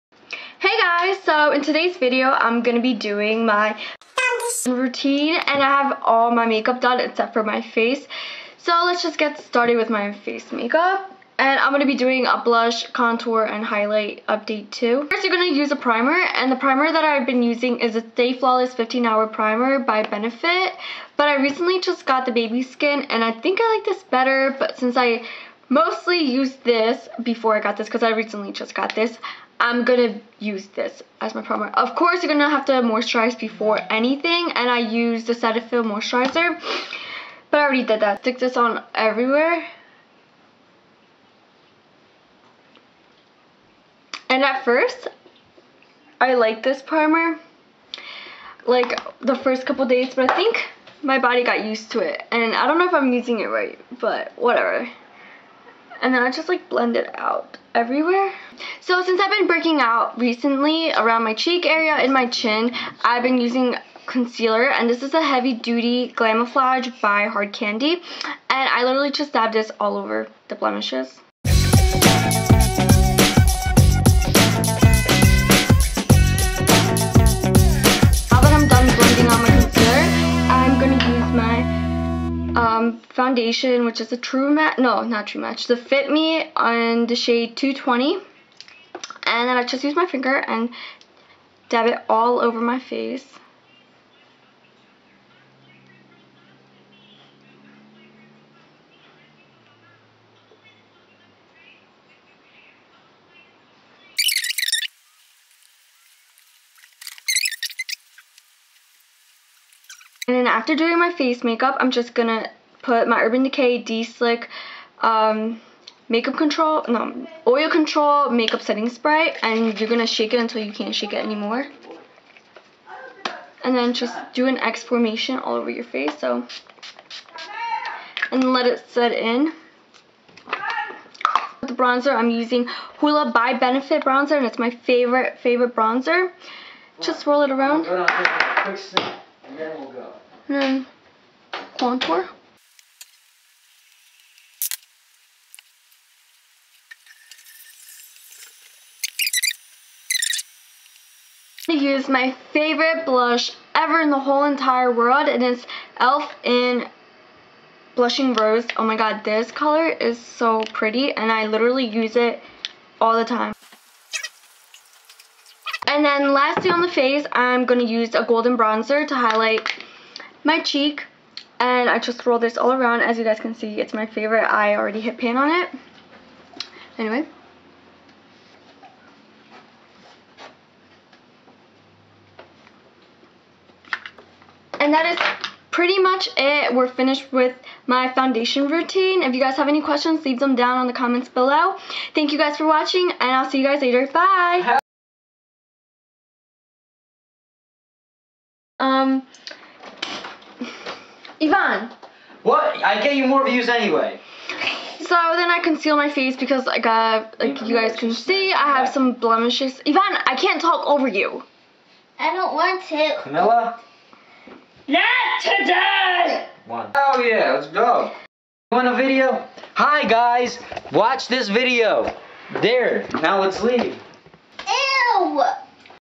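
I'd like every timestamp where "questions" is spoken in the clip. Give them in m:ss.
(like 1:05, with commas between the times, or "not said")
3:09.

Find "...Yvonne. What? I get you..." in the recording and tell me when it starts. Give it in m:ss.
3:21.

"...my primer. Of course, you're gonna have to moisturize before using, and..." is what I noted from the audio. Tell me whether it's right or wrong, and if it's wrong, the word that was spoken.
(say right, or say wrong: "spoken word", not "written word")
wrong: "anything", not "using".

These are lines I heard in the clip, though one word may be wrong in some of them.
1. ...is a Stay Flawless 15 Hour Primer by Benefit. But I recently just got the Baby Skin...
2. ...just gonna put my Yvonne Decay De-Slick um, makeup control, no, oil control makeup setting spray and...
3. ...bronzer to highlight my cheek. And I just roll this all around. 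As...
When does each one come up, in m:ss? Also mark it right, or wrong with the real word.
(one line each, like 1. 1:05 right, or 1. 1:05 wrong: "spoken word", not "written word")
1. 0:17 right
2. 1:51 wrong: "Urban", not "Yvonne"
3. 2:48 right.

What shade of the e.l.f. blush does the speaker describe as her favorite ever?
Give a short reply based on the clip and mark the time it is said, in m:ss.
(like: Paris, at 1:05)
Blushing Rose, at 2:37.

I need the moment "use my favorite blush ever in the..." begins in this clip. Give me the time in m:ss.
2:31.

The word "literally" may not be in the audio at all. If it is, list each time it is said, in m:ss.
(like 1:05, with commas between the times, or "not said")
1:08, 2:41.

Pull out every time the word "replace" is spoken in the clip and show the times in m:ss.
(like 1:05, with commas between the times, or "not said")
not said.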